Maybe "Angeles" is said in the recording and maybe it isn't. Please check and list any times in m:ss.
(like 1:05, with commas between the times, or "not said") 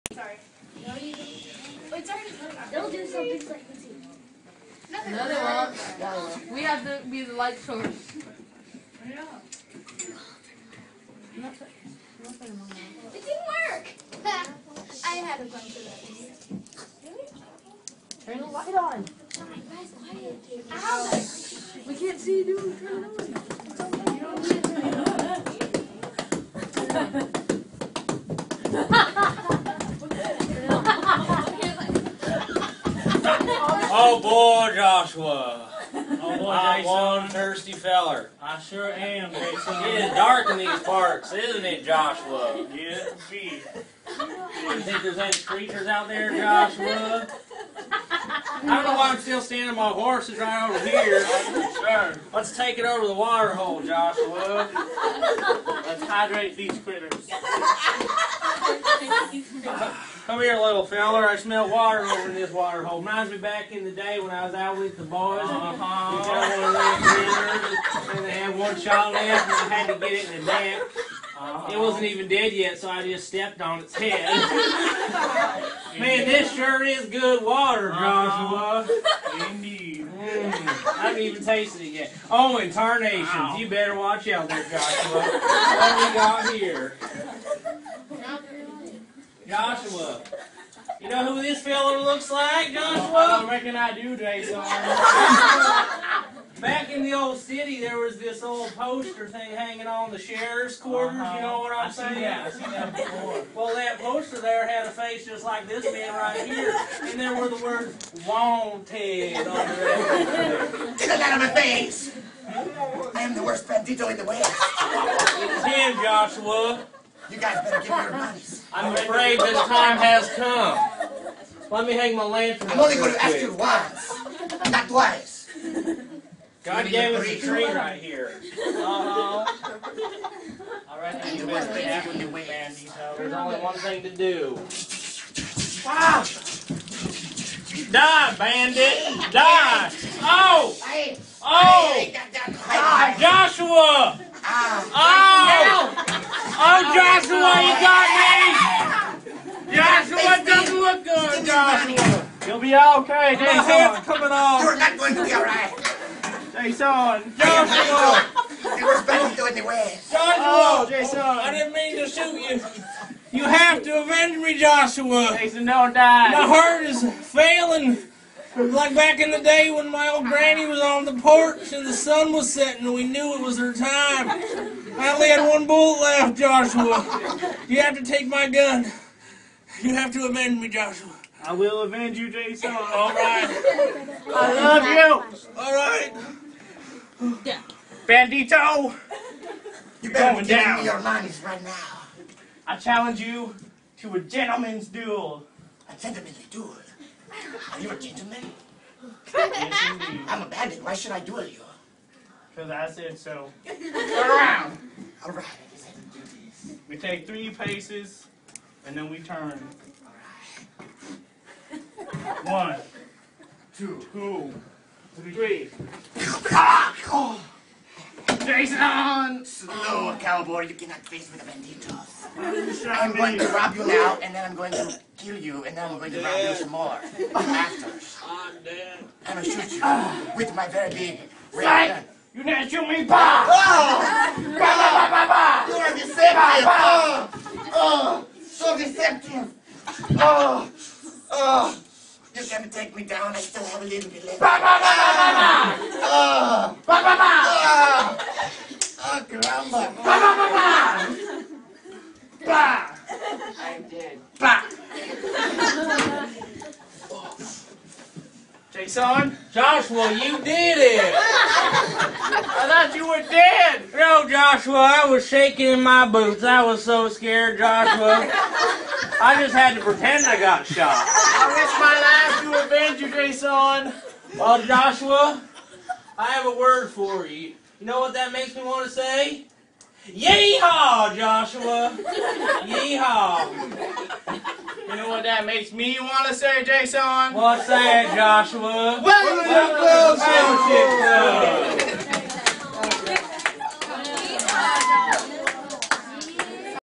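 not said.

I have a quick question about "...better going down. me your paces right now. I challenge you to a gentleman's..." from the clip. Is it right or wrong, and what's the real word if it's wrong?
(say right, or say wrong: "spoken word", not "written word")
wrong: "monies", not "paces".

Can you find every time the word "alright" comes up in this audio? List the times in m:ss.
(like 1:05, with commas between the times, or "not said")
2:35.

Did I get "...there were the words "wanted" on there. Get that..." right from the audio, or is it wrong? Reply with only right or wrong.
right.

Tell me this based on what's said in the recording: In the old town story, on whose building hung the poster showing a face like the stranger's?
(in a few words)
the sheriff's quarters.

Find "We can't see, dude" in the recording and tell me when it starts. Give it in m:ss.
0:21.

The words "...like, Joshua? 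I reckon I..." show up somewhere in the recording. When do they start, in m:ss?
1:32.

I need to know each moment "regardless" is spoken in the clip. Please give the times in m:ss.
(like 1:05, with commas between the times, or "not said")
not said.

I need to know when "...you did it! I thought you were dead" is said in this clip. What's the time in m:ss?
4:20.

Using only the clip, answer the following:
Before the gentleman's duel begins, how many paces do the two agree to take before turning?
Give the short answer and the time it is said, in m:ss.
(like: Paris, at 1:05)
3, at 3:27.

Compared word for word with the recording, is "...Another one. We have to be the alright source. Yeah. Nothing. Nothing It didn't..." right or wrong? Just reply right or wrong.
wrong.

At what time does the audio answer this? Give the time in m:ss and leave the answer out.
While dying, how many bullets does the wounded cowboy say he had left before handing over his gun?
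2:55.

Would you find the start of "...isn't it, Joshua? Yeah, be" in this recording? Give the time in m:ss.
0:41.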